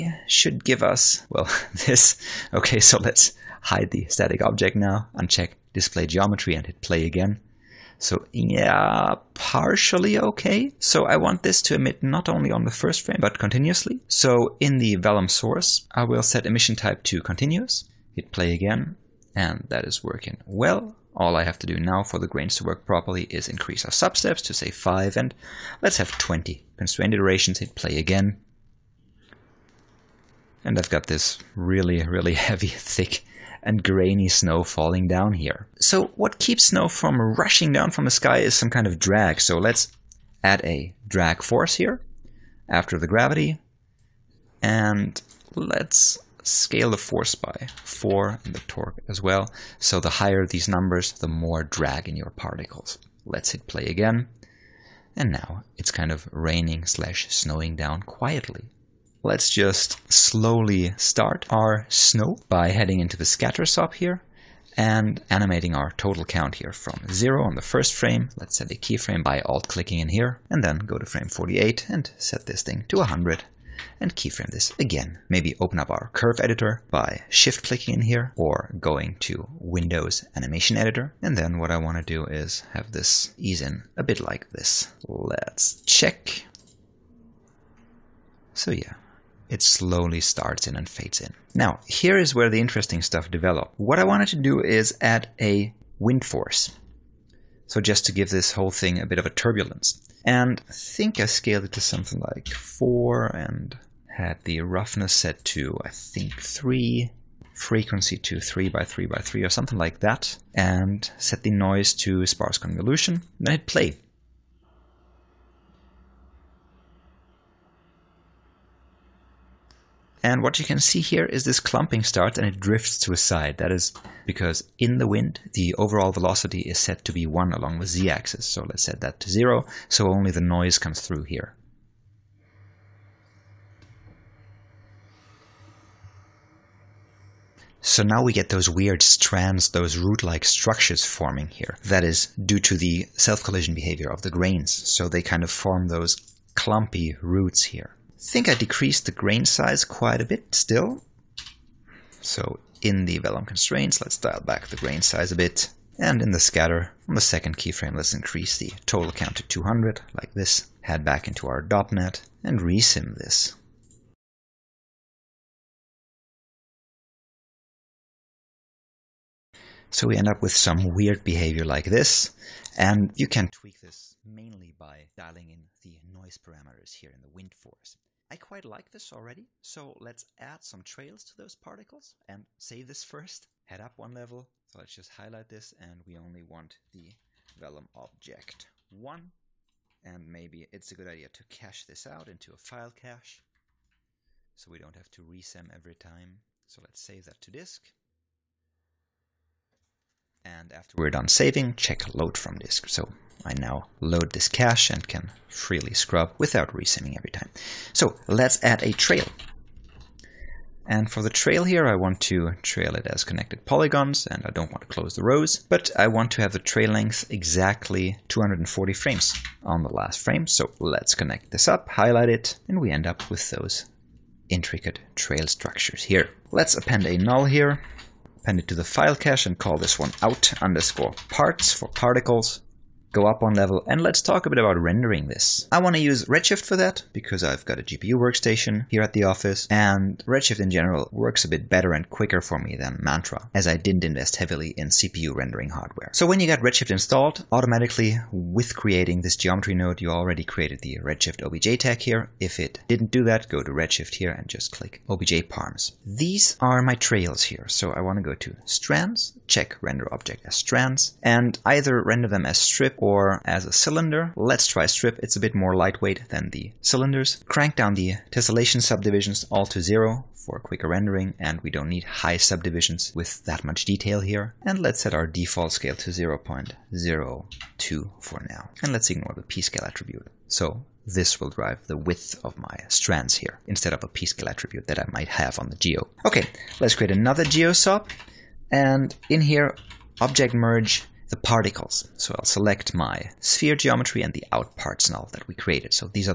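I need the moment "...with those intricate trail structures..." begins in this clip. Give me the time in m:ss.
3:43.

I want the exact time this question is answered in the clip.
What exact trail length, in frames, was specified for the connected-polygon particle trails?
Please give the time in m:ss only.
3:38.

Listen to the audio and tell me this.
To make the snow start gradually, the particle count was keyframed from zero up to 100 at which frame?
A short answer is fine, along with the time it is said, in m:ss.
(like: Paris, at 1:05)
48, at 1:10.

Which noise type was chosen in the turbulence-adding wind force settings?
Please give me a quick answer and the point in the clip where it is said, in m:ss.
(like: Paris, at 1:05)
sparse convolution, at 1:52.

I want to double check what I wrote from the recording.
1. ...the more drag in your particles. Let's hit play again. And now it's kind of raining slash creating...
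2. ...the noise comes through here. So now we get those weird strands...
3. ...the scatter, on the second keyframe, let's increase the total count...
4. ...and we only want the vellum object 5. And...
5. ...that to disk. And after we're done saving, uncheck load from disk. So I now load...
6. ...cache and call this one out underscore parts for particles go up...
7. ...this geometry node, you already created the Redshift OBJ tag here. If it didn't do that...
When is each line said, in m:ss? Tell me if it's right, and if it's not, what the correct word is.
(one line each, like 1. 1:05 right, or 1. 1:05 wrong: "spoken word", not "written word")
1. 0:51 wrong: "snowing", not "creating"
2. 2:10 right
3. 2:36 right
4. 3:05 wrong: "1", not "5"
5. 3:17 wrong: "check", not "uncheck"
6. 3:49 right
7. 4:09 right.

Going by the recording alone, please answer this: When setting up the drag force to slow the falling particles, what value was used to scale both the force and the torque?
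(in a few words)
4.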